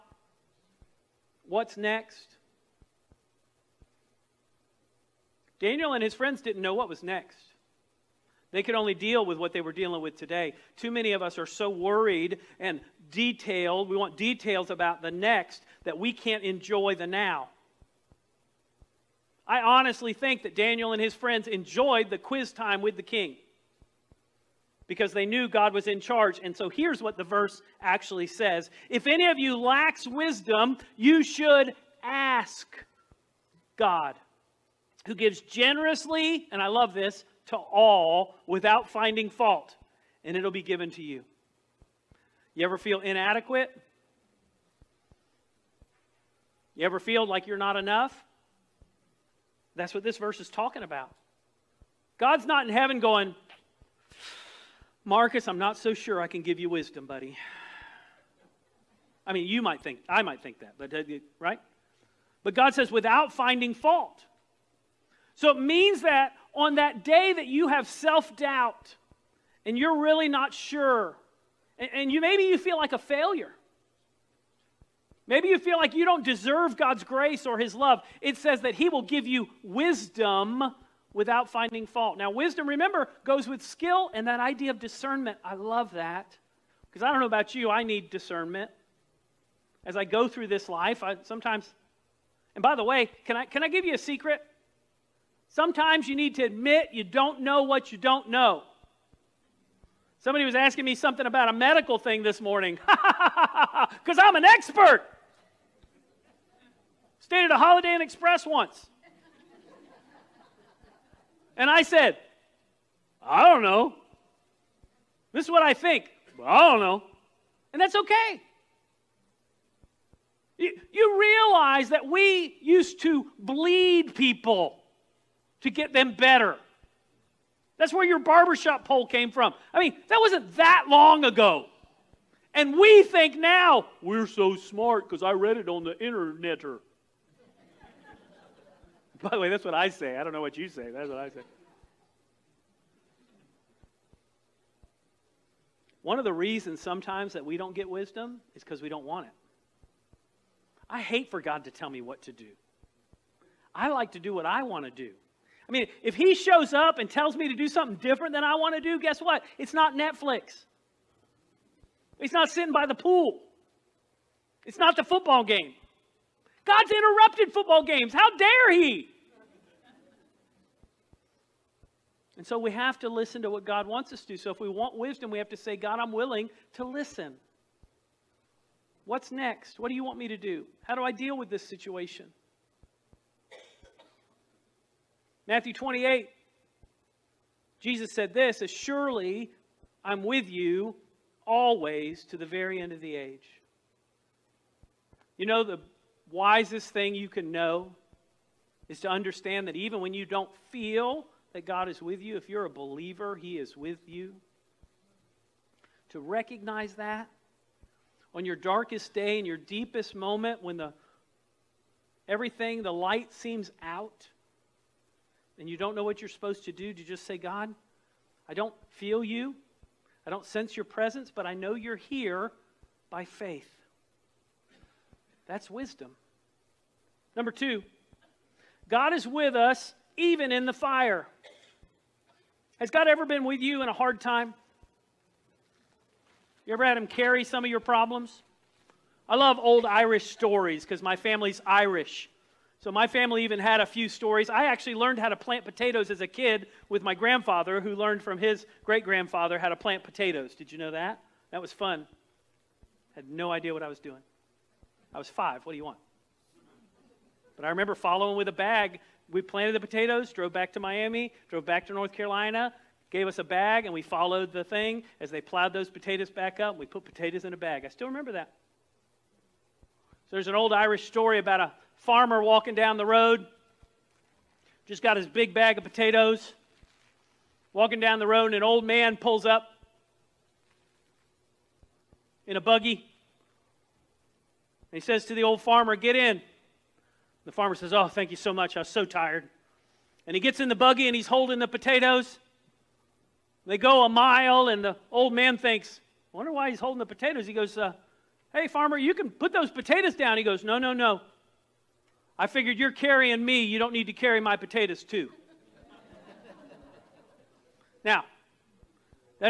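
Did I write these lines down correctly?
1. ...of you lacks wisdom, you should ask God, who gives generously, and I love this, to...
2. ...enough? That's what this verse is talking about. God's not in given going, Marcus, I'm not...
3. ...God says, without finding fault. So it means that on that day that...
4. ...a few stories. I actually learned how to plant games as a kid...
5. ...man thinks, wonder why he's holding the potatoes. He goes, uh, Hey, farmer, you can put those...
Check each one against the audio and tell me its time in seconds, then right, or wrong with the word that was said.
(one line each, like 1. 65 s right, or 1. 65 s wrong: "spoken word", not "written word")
1. 29 s right
2. 47 s wrong: "heaven", not "given"
3. 62 s right
4. 243 s wrong: "potatoes", not "games"
5. 295 s right.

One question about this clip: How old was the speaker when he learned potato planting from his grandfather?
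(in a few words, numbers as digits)
5.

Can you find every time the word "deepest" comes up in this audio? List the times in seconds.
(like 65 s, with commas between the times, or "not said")
209 s.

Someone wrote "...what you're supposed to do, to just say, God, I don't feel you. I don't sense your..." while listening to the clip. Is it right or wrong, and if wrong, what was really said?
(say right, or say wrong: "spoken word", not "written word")
right.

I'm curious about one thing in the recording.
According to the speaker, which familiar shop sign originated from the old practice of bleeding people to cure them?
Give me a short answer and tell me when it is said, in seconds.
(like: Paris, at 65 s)
barbershop pole, at 128 s.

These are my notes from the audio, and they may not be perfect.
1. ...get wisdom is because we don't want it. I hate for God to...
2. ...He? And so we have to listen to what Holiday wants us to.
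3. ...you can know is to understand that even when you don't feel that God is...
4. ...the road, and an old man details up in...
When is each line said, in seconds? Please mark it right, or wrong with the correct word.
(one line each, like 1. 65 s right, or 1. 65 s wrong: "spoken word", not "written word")
1. 147 s right
2. 168 s wrong: "God", not "Holiday"
3. 197 s right
4. 278 s wrong: "pulls", not "details".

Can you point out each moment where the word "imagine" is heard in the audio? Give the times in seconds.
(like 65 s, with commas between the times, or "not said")
not said.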